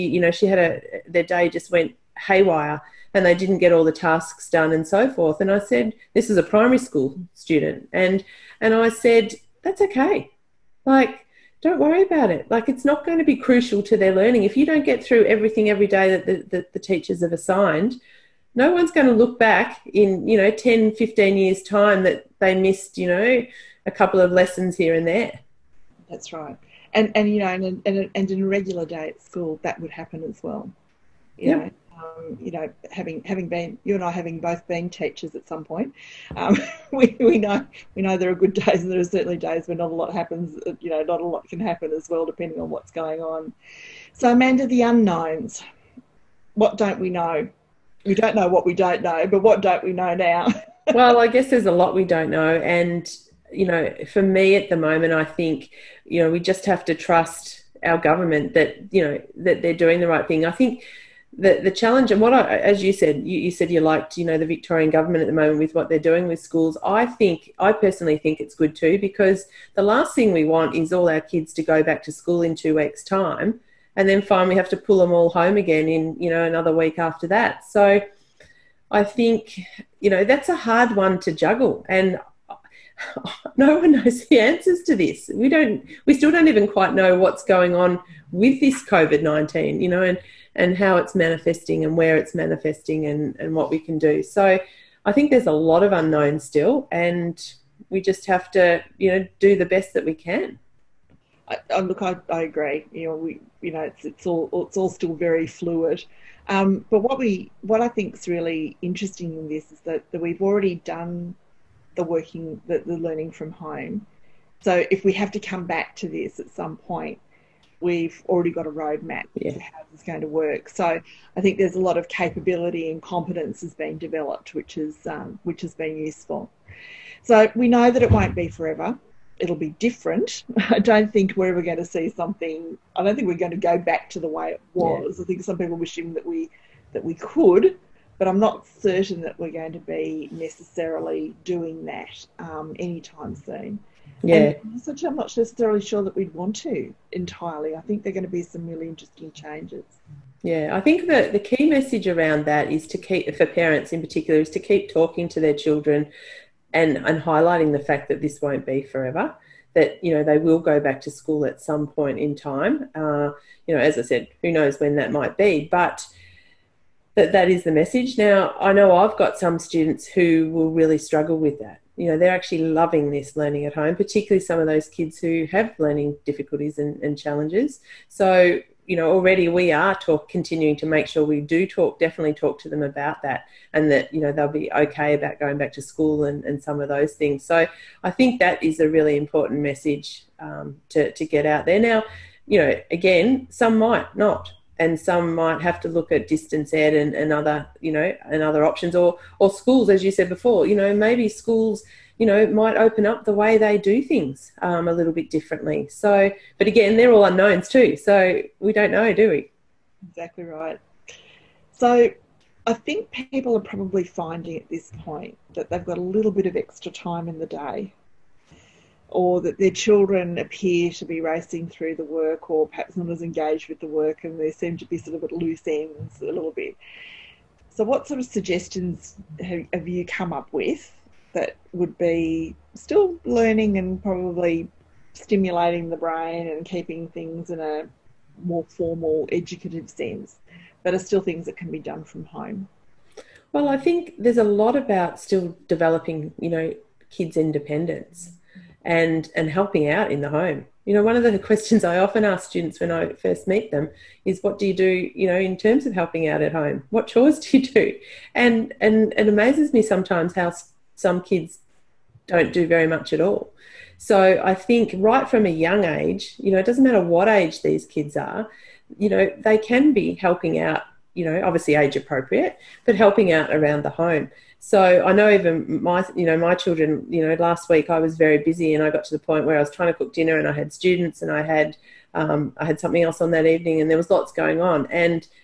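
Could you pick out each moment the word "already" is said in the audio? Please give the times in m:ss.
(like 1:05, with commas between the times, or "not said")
1:50, 1:58, 2:59.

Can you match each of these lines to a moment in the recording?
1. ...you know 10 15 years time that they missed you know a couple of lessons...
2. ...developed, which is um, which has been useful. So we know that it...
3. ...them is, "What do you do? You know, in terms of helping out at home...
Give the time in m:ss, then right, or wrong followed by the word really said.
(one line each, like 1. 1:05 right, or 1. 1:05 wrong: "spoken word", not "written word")
1. 0:20 right
2. 2:03 right
3. 4:13 right.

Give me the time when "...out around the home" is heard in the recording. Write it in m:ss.
4:33.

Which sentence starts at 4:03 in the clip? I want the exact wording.
Well, I think there's a lot about still developing, you know, kids' independence and and helping out in the home.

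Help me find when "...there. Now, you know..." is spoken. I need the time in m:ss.
3:11.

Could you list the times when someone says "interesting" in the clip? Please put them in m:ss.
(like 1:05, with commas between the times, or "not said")
1:48, 2:28.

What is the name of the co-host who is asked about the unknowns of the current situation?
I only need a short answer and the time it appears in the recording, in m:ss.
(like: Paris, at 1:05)
Amanda, at 0:44.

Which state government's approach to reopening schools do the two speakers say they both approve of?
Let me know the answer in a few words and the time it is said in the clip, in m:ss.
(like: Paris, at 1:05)
Victorian, at 1:04.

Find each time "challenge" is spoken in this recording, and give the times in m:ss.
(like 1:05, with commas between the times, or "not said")
1:01, 2:57.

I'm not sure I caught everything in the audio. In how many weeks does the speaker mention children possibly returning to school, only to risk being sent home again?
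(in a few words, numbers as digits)
2.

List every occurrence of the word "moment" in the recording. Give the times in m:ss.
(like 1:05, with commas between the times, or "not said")
0:54, 1:05.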